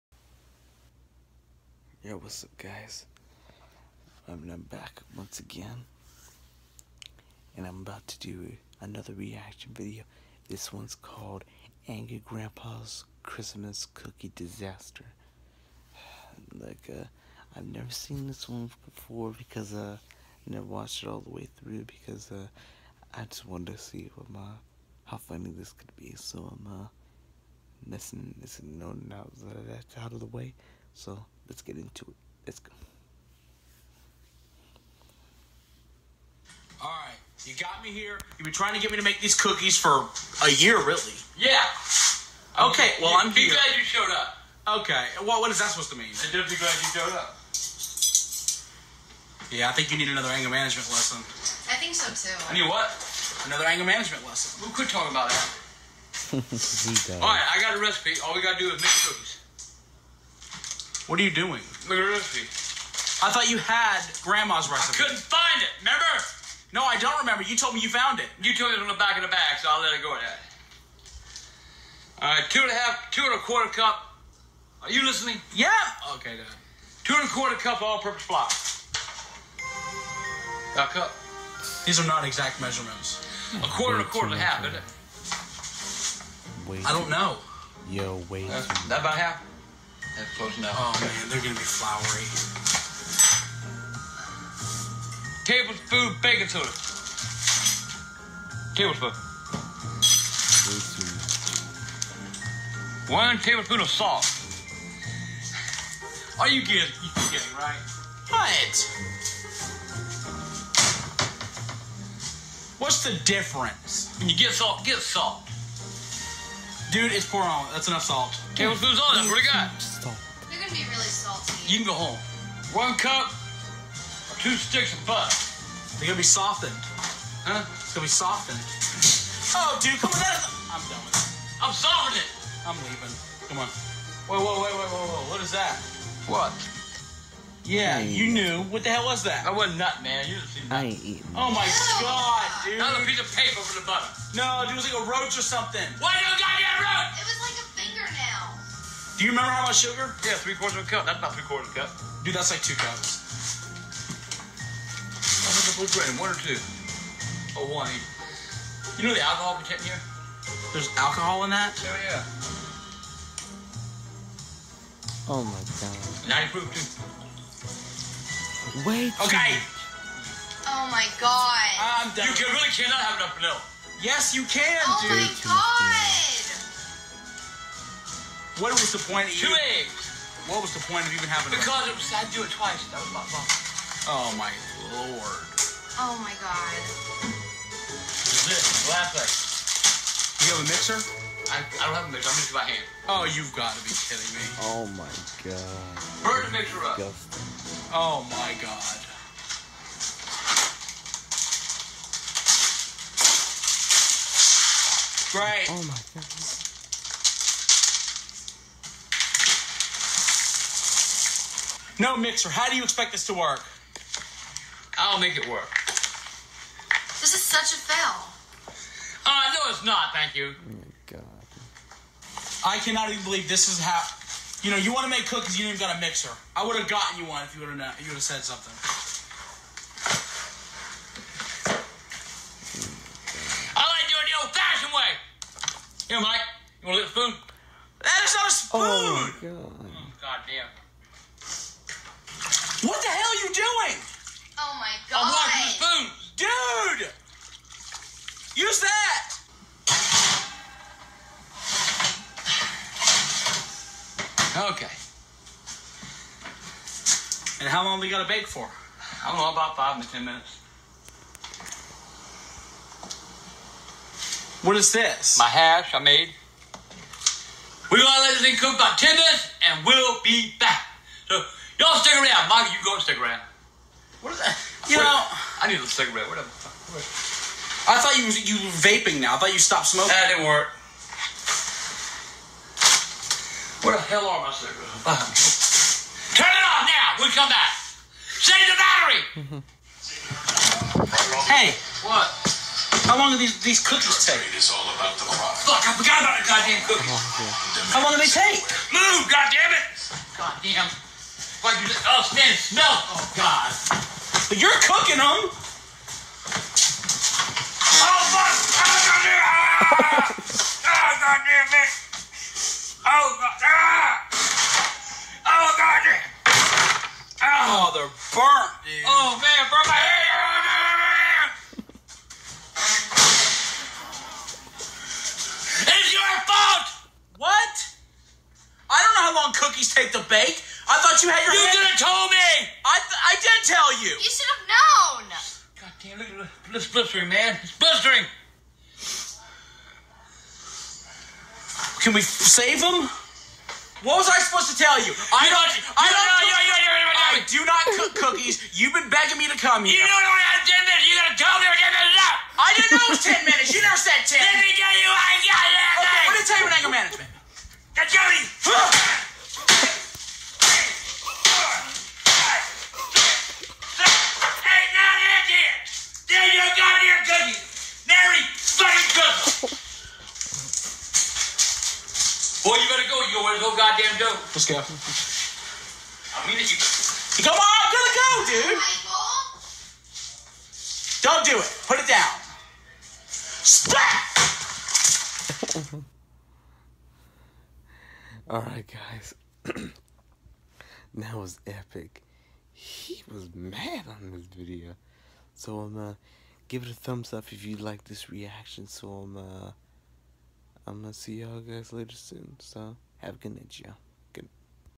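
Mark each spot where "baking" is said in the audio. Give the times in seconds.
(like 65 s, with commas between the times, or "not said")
96 s.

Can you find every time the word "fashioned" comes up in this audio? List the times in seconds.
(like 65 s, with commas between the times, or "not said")
234 s.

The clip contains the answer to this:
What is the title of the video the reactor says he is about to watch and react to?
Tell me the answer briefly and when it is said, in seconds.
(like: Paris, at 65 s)
Angry Grandpa's Christmas Cookie Disaster, at 11 s.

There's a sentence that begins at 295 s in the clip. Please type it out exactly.
Fuck, I forgot about the goddamn cookies.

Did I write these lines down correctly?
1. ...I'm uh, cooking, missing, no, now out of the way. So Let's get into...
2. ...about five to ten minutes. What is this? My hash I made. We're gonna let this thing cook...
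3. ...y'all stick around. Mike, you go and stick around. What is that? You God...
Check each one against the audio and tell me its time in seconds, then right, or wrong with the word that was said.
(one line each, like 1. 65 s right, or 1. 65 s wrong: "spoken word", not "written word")
1. 26 s wrong: "missing", not "cooking"
2. 259 s right
3. 271 s wrong: "Wait", not "God".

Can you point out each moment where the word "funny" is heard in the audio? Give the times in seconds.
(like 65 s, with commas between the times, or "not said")
25 s.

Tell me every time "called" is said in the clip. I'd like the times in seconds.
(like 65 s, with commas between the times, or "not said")
10 s.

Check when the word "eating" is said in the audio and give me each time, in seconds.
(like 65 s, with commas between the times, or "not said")
141 s.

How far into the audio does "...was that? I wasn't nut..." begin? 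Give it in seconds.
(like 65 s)
139 s.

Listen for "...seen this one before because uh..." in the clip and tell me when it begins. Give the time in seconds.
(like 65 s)
17 s.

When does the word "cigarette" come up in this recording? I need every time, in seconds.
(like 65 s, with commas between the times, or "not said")
275 s, 284 s.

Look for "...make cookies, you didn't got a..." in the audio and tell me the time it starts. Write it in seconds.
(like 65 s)
225 s.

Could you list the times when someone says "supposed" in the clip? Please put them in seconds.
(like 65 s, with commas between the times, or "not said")
45 s, 344 s.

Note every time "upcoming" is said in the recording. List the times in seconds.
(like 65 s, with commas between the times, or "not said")
not said.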